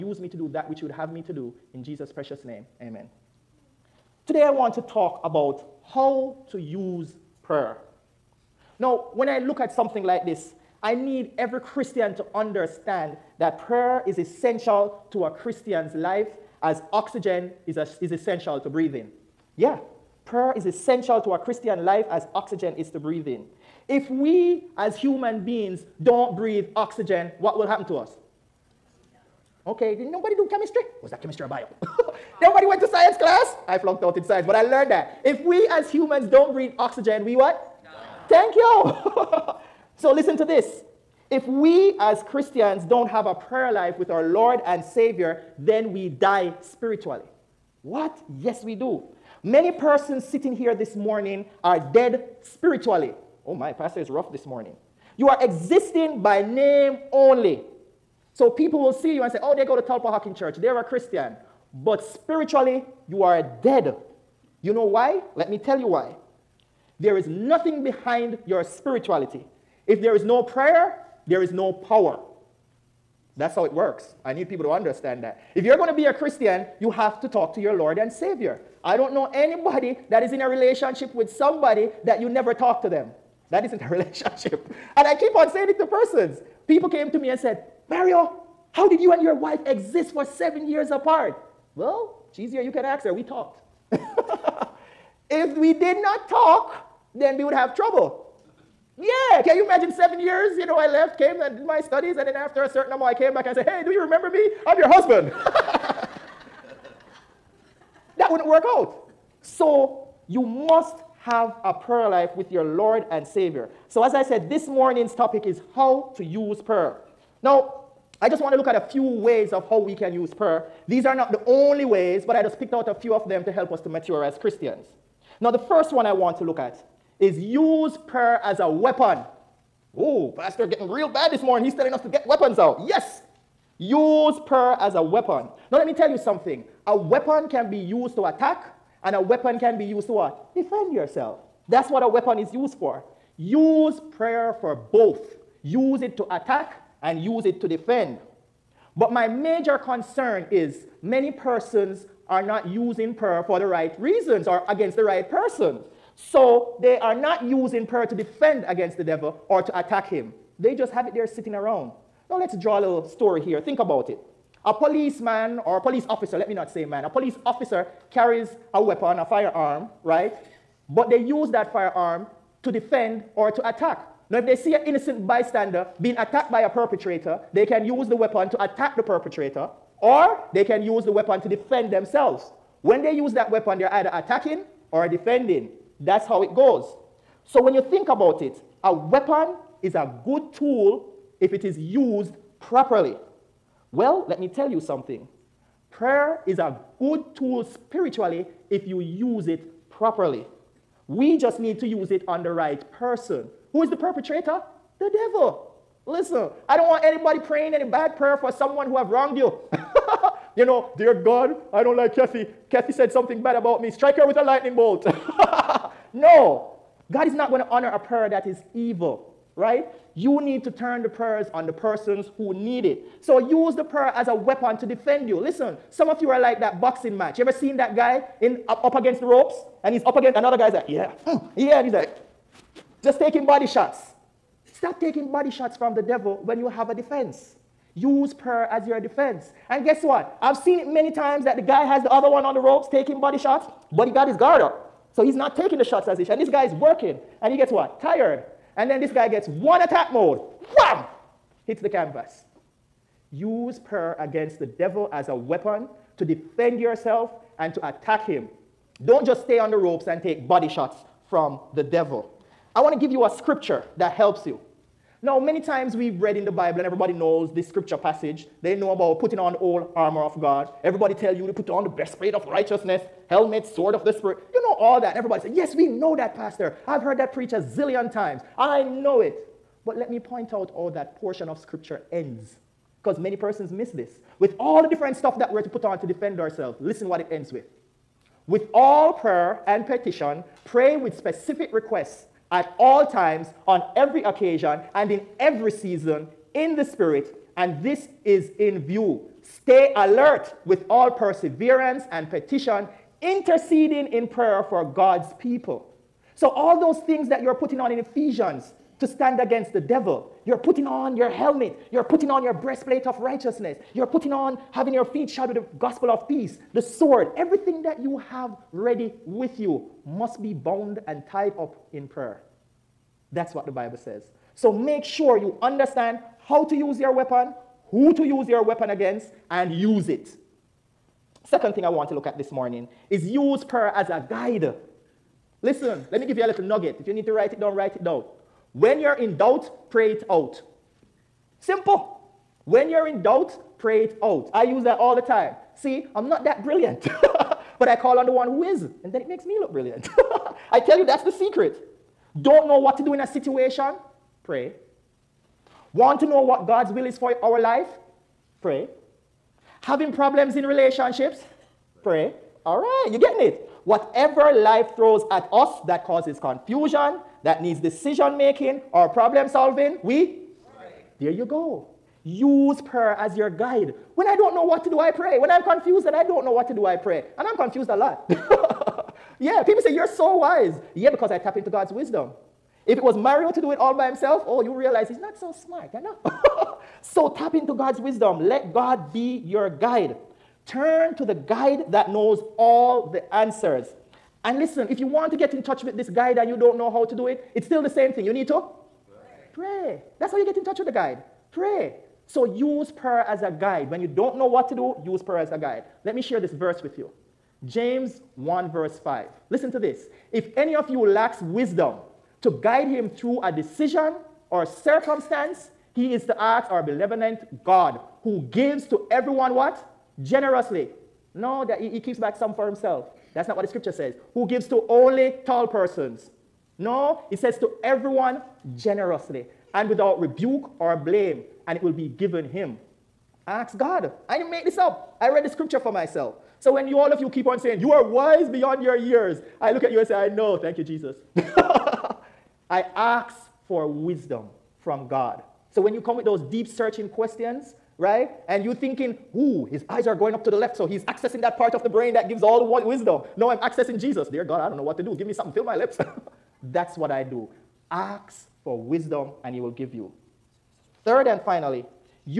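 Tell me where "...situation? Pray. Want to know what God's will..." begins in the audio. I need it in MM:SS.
05:53.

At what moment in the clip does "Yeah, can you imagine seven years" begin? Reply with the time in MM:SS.
01:39.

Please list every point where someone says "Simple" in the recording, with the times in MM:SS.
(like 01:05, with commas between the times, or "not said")
05:41.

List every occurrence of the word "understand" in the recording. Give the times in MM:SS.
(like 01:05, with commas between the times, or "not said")
00:12, 01:14, 05:25.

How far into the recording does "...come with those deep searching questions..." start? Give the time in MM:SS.
07:25.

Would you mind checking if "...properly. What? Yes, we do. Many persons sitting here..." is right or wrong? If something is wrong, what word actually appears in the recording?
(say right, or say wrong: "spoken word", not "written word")
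wrong: "spiritually", not "properly".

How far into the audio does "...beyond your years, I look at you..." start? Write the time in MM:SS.
07:18.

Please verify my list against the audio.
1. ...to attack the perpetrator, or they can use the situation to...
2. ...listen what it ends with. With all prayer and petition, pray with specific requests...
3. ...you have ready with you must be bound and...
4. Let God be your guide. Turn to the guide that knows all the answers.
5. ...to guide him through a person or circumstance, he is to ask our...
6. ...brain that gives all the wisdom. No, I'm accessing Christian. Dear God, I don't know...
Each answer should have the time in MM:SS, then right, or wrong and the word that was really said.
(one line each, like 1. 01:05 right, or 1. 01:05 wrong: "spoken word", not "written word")
1. 02:58 wrong: "weapon", not "situation"
2. 04:46 right
3. 05:17 right
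4. 06:28 right
5. 06:52 wrong: "decision", not "person"
6. 07:31 wrong: "Jesus", not "Christian".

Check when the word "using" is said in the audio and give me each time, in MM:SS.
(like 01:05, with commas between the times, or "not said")
02:32, 02:37.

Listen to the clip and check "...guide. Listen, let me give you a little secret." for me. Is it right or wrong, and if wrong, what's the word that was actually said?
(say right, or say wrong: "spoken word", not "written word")
wrong: "nugget", not "secret".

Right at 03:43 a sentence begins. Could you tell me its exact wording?
So use the prayer as a weapon to defend you.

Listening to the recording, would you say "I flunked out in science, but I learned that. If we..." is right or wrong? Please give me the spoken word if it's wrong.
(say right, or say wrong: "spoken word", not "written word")
right.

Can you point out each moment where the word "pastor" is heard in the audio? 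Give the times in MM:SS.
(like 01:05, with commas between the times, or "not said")
00:53, 02:10, 04:36.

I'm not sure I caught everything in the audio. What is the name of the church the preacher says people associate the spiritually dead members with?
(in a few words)
Talpa Hawking Church.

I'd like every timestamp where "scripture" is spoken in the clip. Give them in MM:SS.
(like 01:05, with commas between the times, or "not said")
04:23, 04:27, 04:41, 07:03, 07:15.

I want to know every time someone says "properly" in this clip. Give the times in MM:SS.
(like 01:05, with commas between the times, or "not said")
03:12, 03:19.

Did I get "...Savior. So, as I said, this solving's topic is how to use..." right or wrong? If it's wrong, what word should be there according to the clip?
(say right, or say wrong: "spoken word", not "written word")
wrong: "morning", not "solving".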